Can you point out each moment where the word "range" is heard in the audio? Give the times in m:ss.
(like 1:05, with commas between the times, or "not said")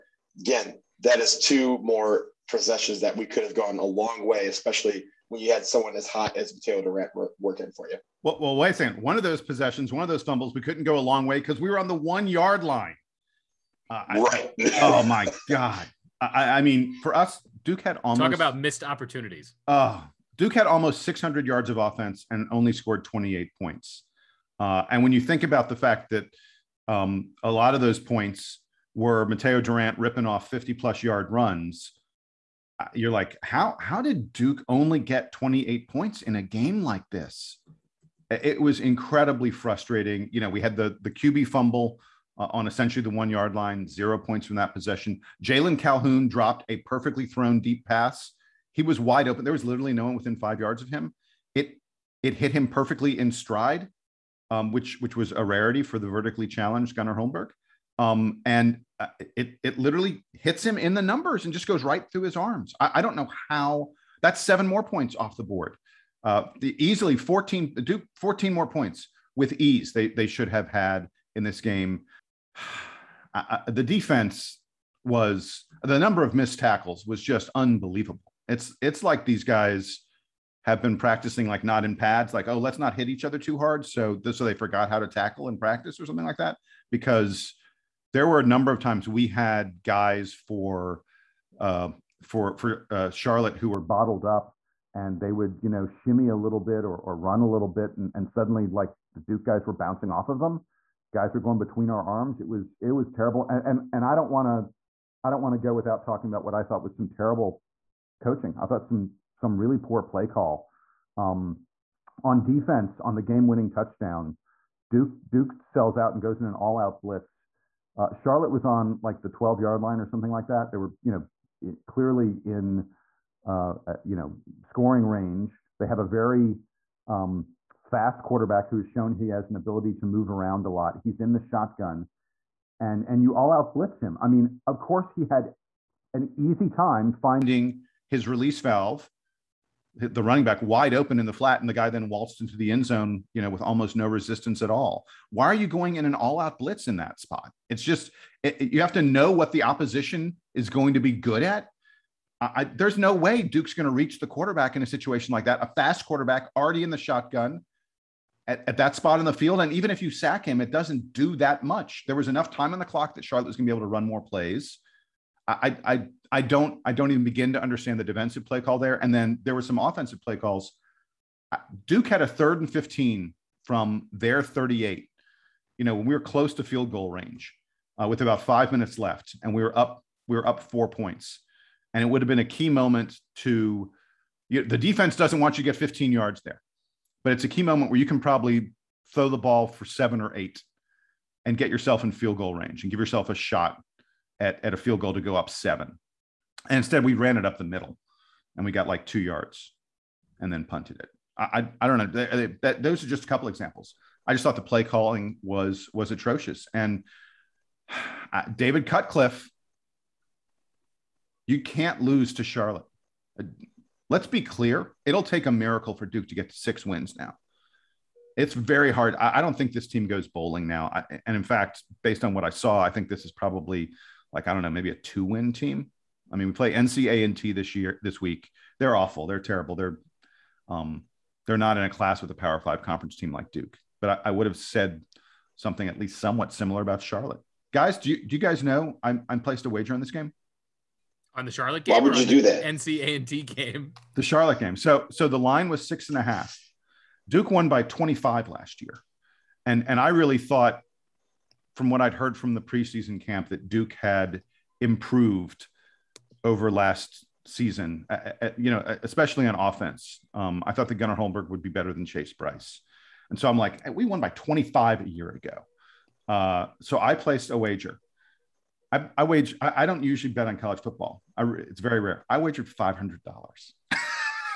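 2:05, 2:57, 3:12.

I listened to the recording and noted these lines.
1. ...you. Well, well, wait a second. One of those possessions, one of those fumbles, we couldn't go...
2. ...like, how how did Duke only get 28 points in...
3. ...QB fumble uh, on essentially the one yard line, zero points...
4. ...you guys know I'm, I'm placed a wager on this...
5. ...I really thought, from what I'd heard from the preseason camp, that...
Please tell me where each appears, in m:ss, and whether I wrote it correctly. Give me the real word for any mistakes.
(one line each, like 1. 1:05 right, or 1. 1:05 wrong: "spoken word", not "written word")
1. 0:07 right
2. 0:33 right
3. 0:41 right
4. 3:58 right
5. 4:09 right.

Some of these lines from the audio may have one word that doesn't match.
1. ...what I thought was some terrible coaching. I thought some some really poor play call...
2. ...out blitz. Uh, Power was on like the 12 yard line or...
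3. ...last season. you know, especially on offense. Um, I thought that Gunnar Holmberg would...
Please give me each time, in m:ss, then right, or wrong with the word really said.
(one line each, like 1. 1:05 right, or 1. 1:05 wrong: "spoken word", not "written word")
1. 1:46 right
2. 1:56 wrong: "Charlotte", not "Power"
3. 4:16 right.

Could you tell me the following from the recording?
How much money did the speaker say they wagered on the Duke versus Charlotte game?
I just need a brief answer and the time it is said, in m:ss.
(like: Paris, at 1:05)
$500, at 4:32.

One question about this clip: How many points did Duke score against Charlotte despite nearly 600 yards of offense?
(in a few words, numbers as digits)
28.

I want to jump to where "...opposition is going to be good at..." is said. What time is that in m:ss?
2:29.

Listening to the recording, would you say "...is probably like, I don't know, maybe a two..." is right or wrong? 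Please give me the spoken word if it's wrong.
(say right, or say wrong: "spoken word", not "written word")
right.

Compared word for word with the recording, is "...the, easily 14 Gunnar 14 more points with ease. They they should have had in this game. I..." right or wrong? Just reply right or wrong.
wrong.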